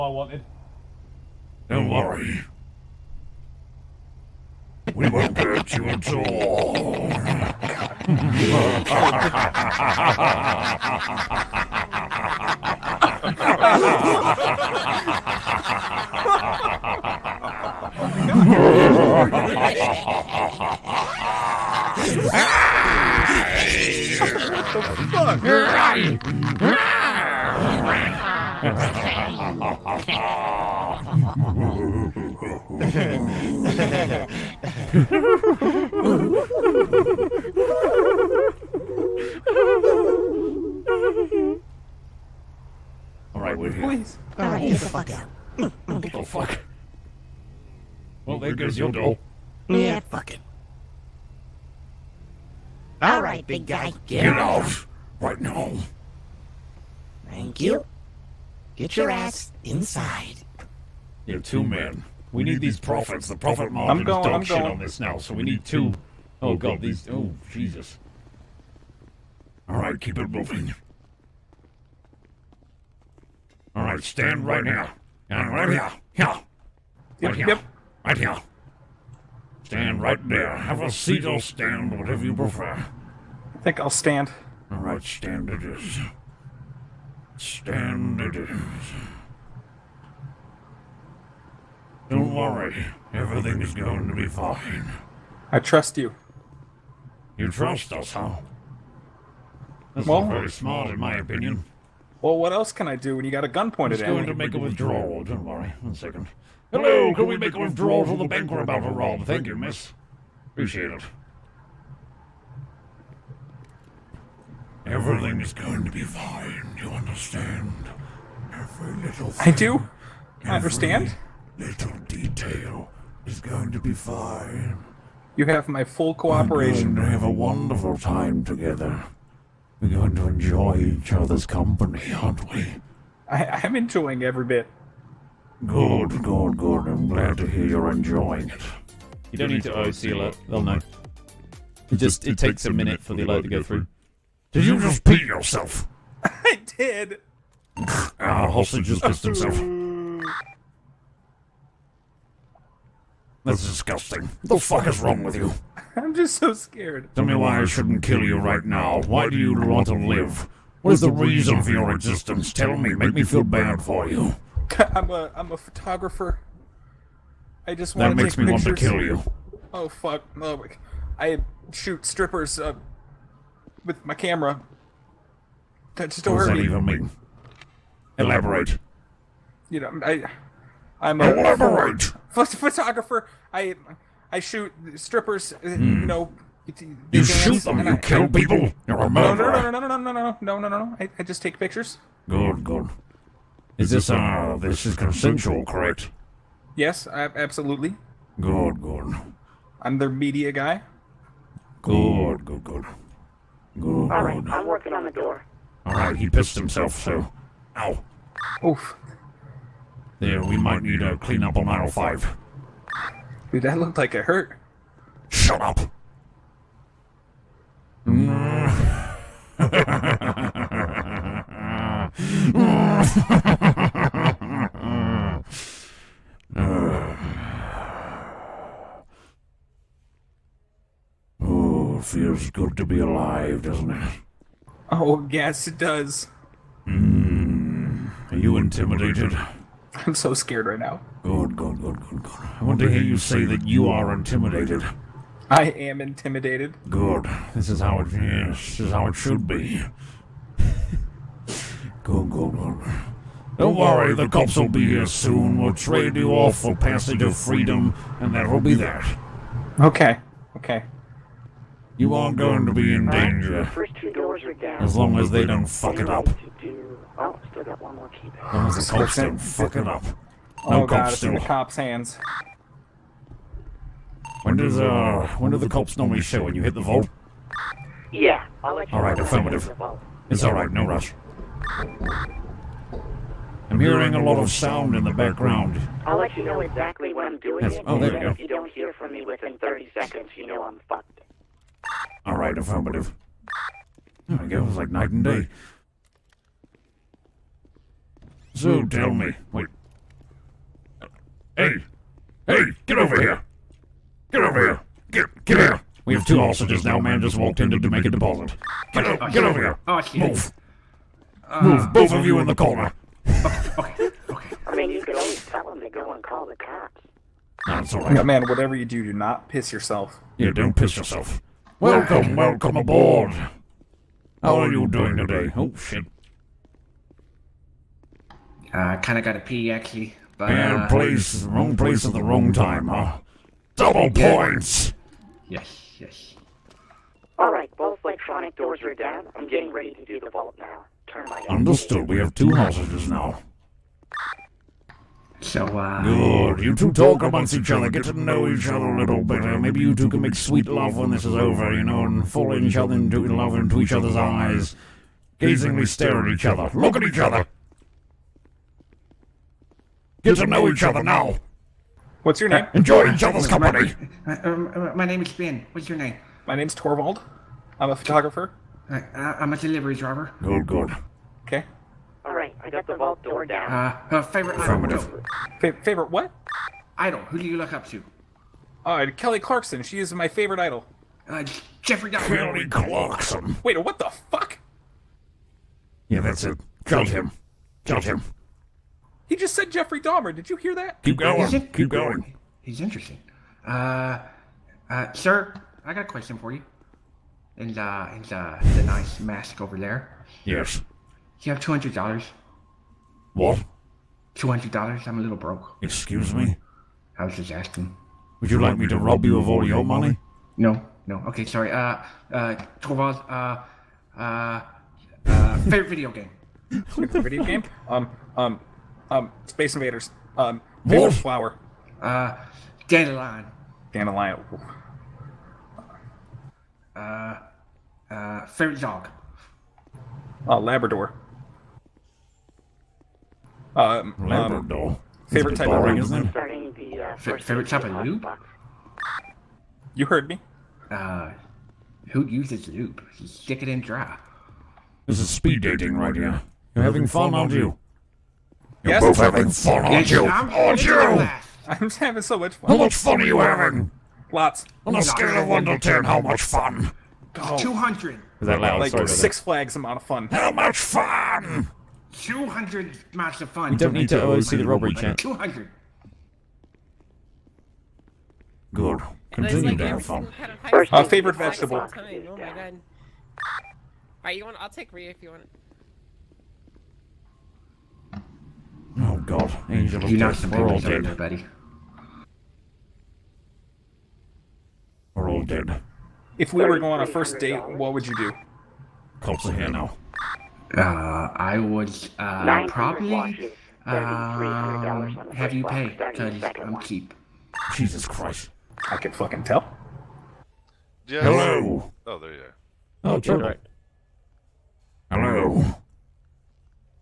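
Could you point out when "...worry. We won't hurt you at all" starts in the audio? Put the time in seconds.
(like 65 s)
1 s.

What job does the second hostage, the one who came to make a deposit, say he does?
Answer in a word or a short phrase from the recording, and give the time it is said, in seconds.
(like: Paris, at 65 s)
Delivery driver, at 369 s.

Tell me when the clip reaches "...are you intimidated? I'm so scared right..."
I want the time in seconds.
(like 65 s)
238 s.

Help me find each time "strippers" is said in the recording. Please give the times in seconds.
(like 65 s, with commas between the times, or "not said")
172 s, 184 s.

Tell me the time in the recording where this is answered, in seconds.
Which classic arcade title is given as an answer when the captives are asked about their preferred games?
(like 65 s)
419 s.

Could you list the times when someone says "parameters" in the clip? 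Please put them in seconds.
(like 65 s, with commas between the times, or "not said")
not said.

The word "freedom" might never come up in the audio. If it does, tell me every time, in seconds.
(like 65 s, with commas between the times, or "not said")
257 s.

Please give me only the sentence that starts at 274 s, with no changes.
When does uh when do the cops normally show when you hit the vault?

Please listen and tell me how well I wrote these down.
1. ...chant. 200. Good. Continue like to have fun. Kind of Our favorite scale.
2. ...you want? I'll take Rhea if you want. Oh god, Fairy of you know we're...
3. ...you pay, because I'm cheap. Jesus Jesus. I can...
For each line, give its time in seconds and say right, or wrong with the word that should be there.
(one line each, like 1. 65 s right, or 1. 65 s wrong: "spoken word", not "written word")
1. 464 s wrong: "vegetable", not "scale"
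2. 474 s wrong: "Angel", not "Fairy"
3. 495 s wrong: "Christ", not "Jesus".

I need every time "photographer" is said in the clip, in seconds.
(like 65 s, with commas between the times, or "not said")
165 s, 182 s, 367 s.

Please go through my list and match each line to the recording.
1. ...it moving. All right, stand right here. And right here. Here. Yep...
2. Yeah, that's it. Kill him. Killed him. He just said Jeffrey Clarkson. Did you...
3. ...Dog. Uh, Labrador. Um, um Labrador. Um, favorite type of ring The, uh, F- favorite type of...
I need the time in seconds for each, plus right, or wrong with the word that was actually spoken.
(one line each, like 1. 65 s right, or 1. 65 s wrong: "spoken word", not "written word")
1. 70 s right
2. 386 s wrong: "Dahmer", not "Clarkson"
3. 428 s right.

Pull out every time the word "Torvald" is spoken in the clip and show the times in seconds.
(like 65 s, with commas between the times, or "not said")
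366 s, 412 s.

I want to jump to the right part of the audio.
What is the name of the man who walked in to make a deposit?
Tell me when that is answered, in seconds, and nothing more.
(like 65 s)
364 s.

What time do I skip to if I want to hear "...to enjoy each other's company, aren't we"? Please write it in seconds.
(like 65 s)
130 s.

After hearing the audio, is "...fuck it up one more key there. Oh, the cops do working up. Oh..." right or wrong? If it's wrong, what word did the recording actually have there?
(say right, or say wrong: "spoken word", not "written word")
wrong: "fucking", not "working".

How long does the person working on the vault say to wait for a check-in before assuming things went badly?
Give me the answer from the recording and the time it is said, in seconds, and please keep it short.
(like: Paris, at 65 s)
30 seconds, at 289 s.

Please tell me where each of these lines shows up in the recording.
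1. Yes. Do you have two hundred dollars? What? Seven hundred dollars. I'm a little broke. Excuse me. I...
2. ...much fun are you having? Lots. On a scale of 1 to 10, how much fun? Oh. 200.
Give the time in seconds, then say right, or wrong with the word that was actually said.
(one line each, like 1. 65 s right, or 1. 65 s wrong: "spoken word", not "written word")
1. 400 s wrong: "Two", not "Seven"
2. 452 s right.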